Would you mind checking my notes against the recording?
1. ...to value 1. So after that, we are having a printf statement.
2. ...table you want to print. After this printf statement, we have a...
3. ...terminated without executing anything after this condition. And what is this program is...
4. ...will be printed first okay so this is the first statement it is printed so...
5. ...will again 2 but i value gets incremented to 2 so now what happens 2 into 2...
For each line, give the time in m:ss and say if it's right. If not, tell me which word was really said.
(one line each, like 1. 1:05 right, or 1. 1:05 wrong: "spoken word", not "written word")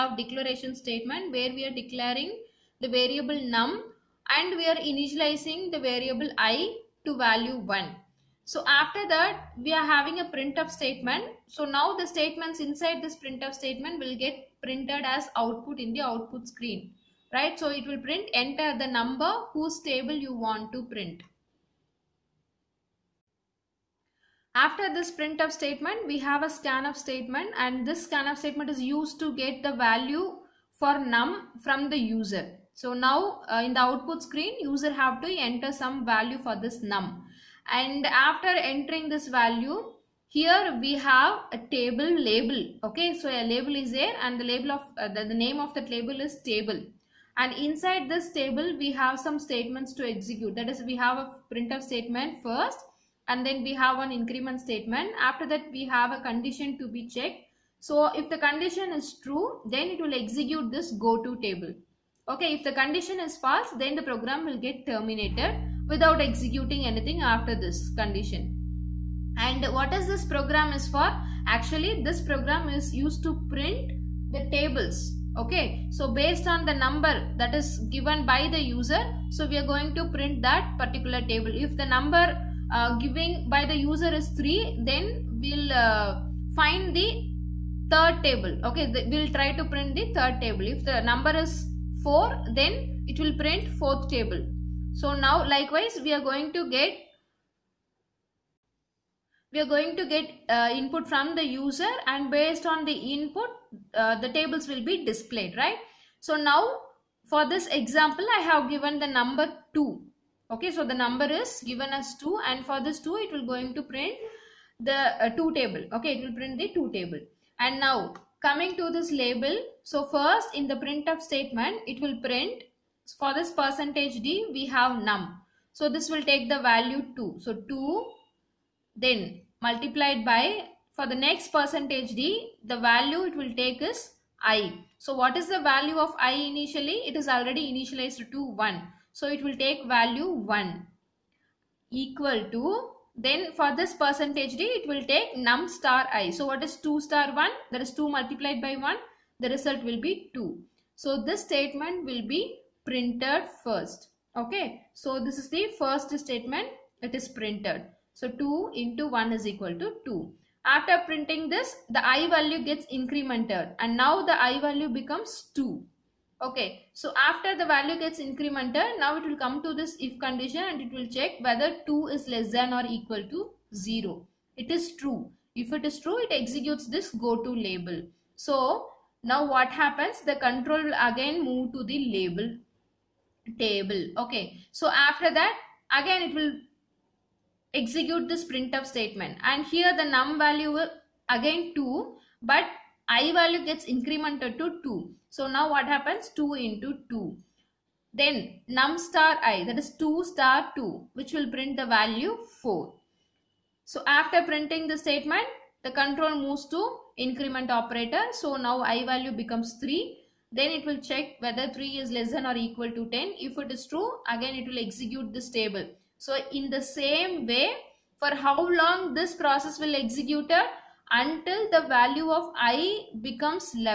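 1. 0:07 right
2. 0:19 right
3. 1:04 right
4. 2:32 right
5. 3:10 right.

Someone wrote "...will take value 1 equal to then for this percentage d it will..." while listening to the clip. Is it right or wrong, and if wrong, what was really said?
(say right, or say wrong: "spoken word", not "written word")
right.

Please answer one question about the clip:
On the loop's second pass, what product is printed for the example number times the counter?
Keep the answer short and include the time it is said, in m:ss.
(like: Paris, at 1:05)
4, at 3:21.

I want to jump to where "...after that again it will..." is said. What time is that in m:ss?
3:04.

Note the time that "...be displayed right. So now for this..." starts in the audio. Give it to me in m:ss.
1:44.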